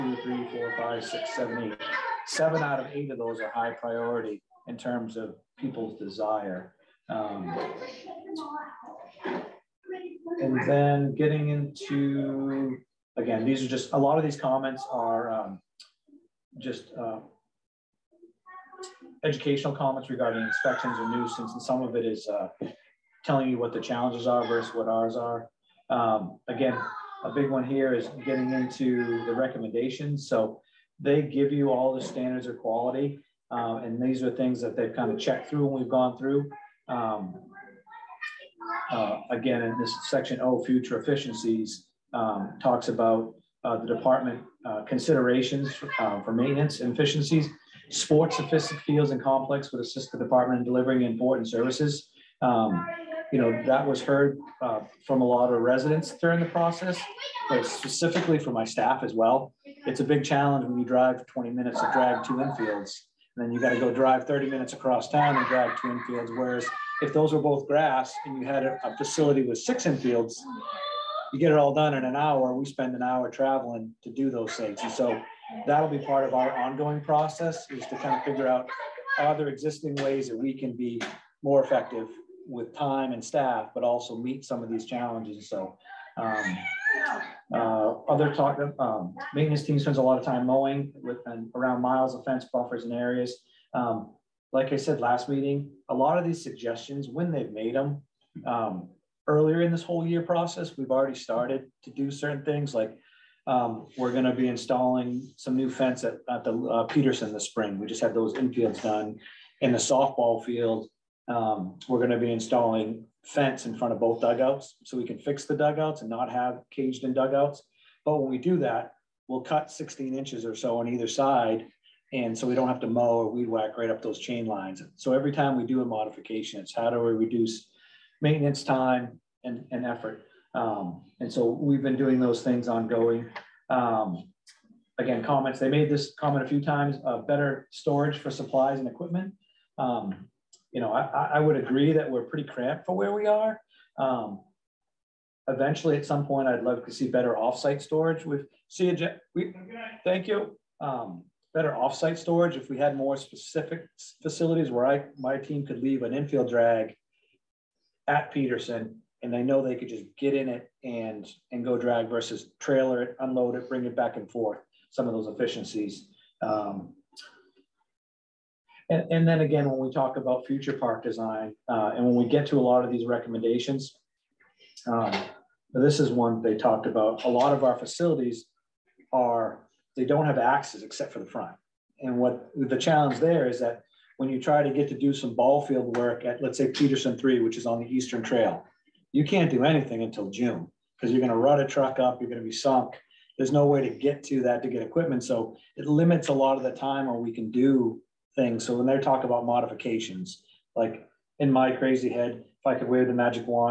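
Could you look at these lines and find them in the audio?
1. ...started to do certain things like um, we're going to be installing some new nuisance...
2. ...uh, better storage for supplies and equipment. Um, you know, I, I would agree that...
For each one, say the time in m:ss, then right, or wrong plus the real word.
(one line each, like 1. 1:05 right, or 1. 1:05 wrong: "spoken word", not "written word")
1. 1:41 wrong: "fence", not "nuisance"
2. 2:17 right.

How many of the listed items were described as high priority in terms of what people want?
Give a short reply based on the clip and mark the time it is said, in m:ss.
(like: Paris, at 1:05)
7 out of 8, at 0:02.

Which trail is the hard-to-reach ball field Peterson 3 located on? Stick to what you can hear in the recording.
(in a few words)
Eastern Trail.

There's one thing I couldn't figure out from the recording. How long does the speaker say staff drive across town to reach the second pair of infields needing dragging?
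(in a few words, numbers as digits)
30 minutes.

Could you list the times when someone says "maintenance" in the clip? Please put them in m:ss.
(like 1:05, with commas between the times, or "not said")
0:46, 1:29, 2:08.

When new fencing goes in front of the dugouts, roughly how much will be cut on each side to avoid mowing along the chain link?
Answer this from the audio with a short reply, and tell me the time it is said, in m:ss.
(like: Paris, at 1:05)
16 inches, at 1:59.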